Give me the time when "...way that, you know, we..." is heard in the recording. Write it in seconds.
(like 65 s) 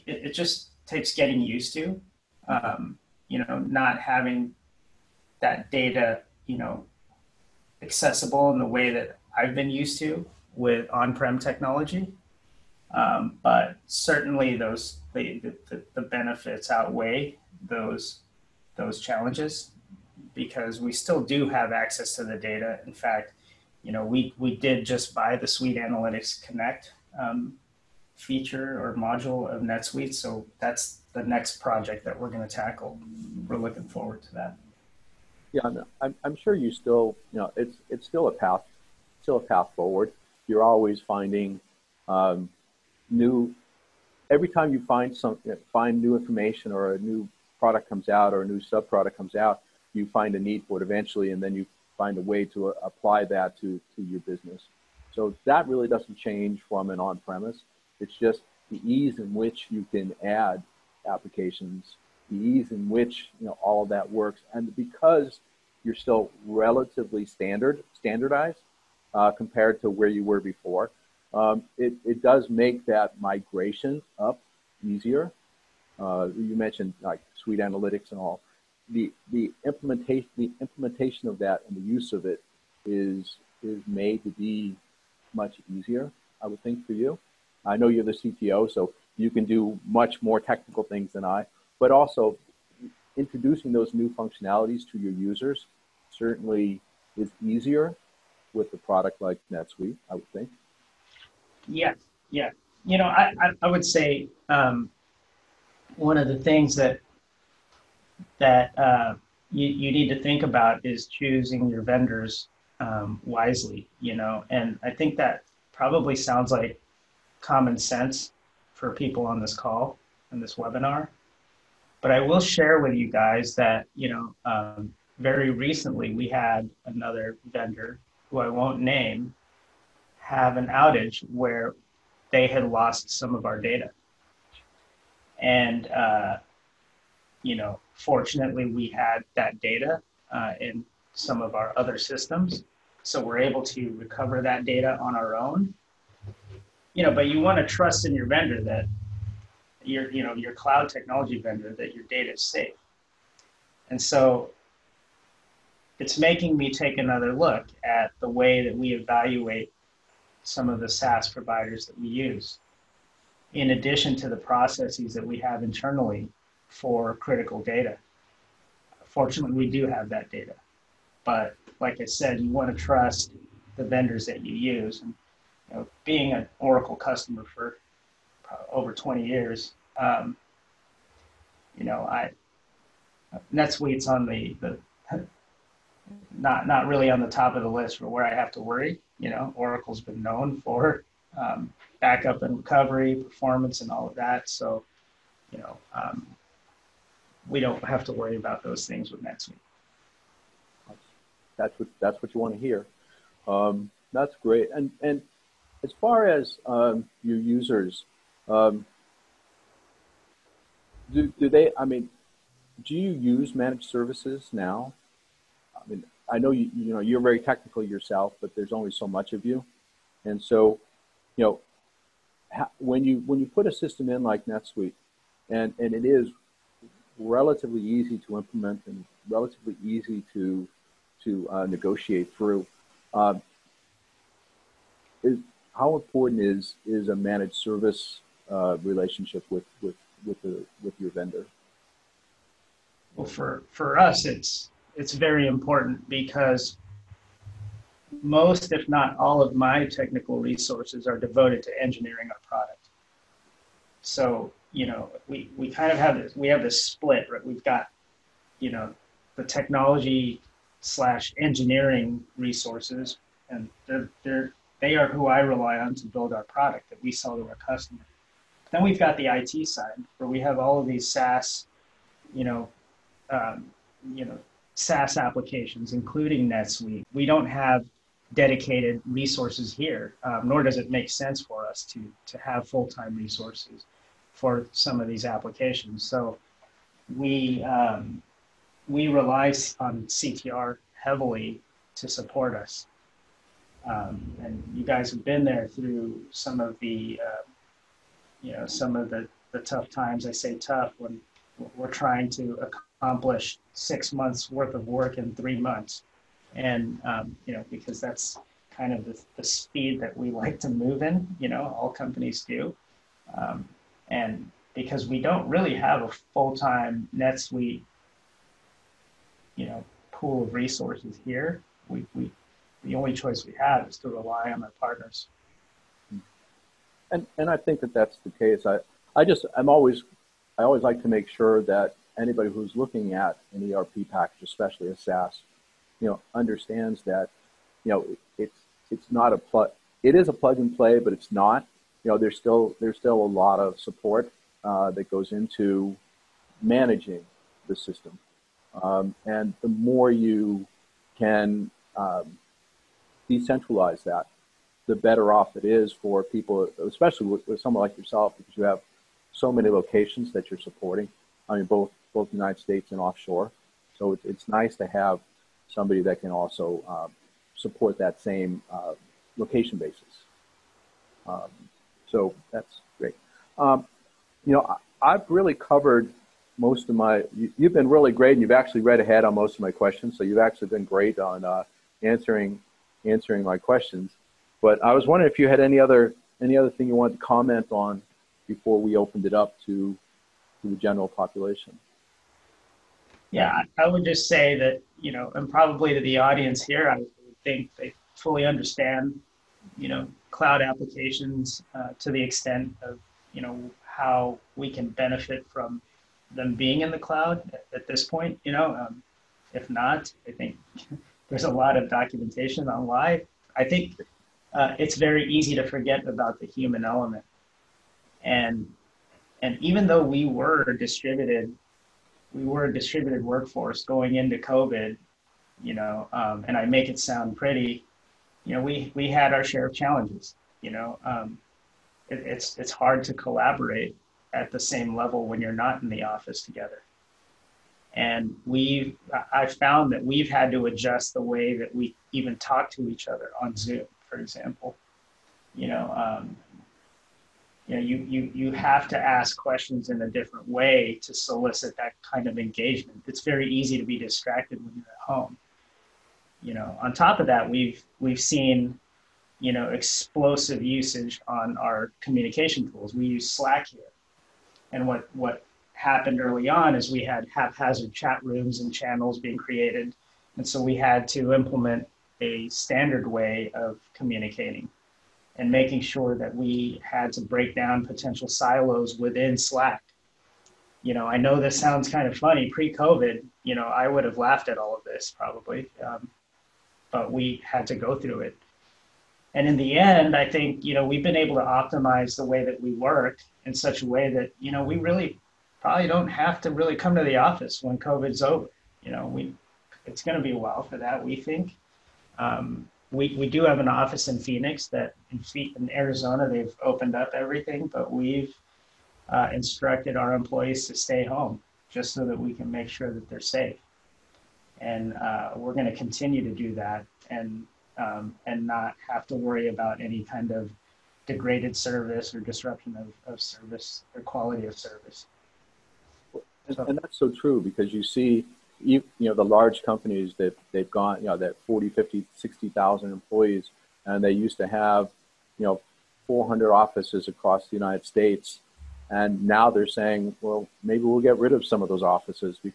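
493 s.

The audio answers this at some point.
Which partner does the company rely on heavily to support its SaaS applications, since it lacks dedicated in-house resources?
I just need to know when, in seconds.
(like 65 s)
290 s.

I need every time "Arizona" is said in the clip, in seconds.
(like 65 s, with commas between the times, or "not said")
505 s.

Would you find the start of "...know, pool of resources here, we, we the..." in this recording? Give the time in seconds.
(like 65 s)
319 s.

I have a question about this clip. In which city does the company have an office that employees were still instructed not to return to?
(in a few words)
Phoenix.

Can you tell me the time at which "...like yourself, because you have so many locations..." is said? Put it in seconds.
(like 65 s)
357 s.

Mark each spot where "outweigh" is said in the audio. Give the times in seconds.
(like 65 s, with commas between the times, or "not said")
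16 s.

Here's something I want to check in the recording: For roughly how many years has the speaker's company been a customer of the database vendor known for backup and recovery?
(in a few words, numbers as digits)
20.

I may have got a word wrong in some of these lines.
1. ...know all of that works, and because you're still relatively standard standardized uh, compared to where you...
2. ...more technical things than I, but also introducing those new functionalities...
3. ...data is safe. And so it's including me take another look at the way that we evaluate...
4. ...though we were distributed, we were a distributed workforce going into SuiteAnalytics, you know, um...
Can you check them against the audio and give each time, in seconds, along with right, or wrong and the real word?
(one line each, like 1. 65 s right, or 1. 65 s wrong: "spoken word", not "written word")
1. 63 s right
2. 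90 s right
3. 152 s wrong: "making", not "including"
4. 419 s wrong: "COVID", not "SuiteAnalytics".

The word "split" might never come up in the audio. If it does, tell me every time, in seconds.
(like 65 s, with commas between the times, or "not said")
256 s.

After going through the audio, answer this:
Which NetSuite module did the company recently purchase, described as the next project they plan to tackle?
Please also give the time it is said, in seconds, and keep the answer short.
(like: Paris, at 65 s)
SuiteAnalytics Connect, at 25 s.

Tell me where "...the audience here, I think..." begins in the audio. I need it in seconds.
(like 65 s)
395 s.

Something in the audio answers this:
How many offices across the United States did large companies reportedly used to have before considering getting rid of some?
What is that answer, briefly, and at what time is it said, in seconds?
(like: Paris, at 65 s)
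400, at 536 s.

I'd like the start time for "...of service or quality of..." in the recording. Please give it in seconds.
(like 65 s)
523 s.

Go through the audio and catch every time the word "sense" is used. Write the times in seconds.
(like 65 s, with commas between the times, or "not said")
117 s, 281 s.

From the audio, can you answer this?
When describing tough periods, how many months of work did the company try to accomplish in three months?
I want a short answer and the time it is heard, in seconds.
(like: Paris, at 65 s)
6, at 303 s.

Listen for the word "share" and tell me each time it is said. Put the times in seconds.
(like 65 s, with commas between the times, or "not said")
122 s, 429 s.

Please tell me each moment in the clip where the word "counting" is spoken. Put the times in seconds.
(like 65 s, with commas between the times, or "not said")
not said.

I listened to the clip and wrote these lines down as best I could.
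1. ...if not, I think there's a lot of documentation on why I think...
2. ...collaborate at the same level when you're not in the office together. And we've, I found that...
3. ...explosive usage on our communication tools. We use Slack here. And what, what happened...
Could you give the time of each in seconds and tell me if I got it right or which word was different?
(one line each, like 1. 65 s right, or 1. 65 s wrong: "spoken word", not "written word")
1. 409 s right
2. 433 s right
3. 459 s right.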